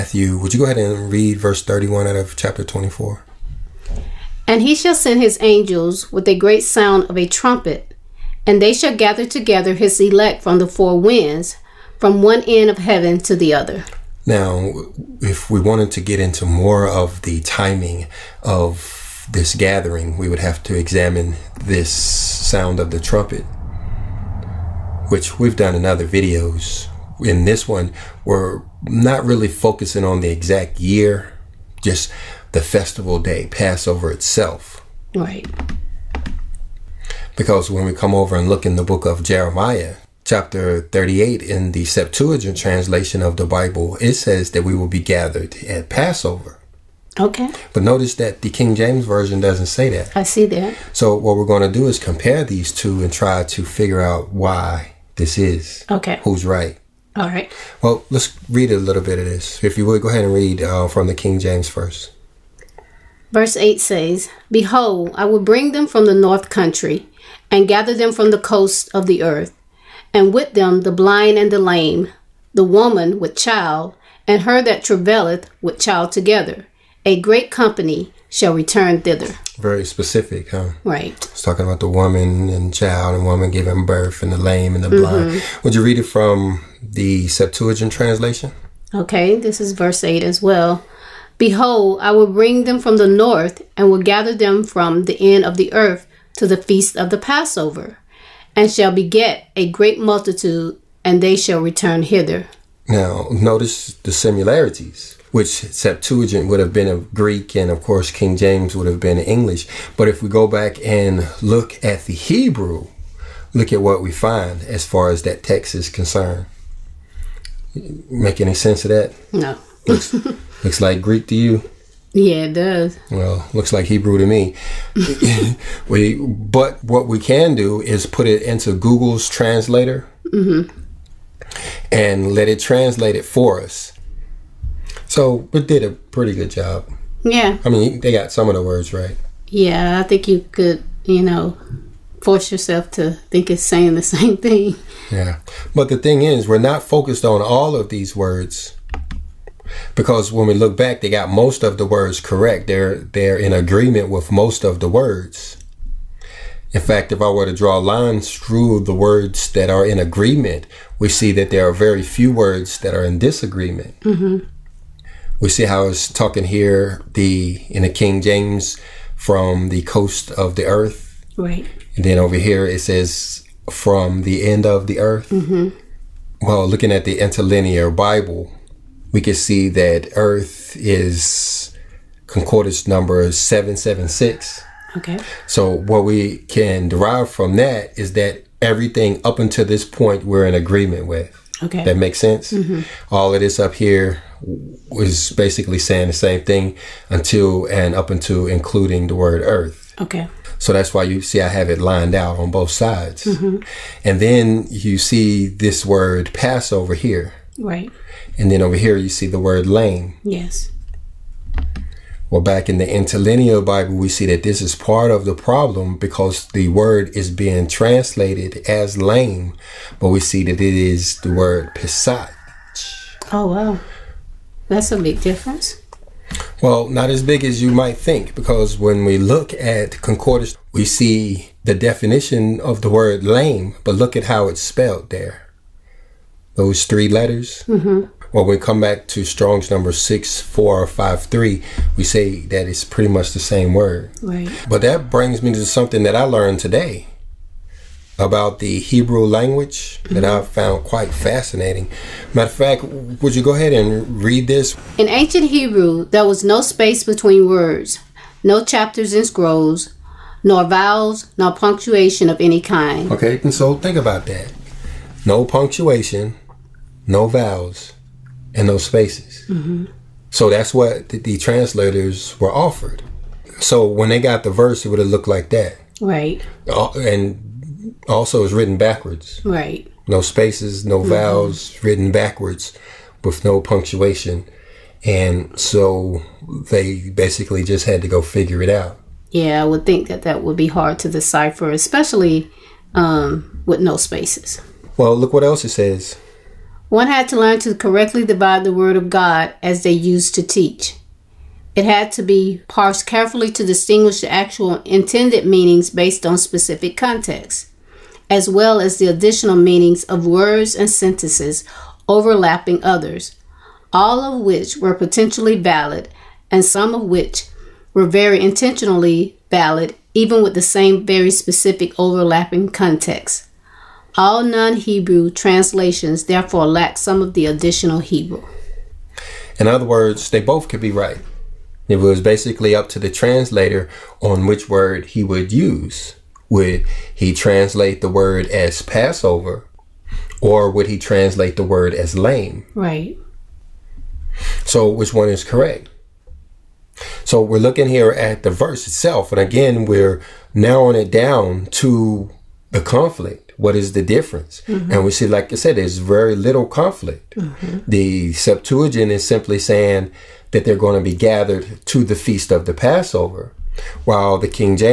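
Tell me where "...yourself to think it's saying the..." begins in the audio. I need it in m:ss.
2:22.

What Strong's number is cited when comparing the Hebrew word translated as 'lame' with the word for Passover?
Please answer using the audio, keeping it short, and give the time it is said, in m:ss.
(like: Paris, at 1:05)
6453, at 3:59.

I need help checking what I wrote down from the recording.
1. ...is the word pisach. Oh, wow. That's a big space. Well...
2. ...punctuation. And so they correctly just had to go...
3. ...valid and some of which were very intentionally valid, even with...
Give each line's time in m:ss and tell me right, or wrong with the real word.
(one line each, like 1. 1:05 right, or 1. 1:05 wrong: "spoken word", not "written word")
1. 3:40 wrong: "difference", not "space"
2. 4:43 wrong: "basically", not "correctly"
3. 5:15 right.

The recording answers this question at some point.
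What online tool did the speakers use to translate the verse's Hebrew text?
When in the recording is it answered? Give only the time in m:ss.
2:08.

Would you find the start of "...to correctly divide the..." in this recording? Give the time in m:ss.
4:57.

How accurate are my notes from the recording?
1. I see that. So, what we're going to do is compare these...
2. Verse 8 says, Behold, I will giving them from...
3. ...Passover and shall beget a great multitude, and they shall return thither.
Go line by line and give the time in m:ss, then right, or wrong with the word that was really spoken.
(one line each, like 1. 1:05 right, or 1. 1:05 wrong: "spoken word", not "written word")
1. 0:50 right
2. 1:03 wrong: "bring", not "giving"
3. 1:37 wrong: "hither", not "thither".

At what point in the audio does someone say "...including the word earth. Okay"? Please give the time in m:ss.
3:18.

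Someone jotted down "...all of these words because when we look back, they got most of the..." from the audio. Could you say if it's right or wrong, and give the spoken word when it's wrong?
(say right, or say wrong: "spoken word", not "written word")
right.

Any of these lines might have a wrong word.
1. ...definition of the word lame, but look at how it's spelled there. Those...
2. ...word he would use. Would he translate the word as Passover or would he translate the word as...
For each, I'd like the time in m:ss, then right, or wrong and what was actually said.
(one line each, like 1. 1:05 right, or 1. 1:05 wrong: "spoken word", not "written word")
1. 3:51 right
2. 5:34 right.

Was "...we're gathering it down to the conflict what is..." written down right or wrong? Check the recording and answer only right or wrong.
wrong.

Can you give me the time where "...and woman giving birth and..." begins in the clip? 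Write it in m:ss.
1:23.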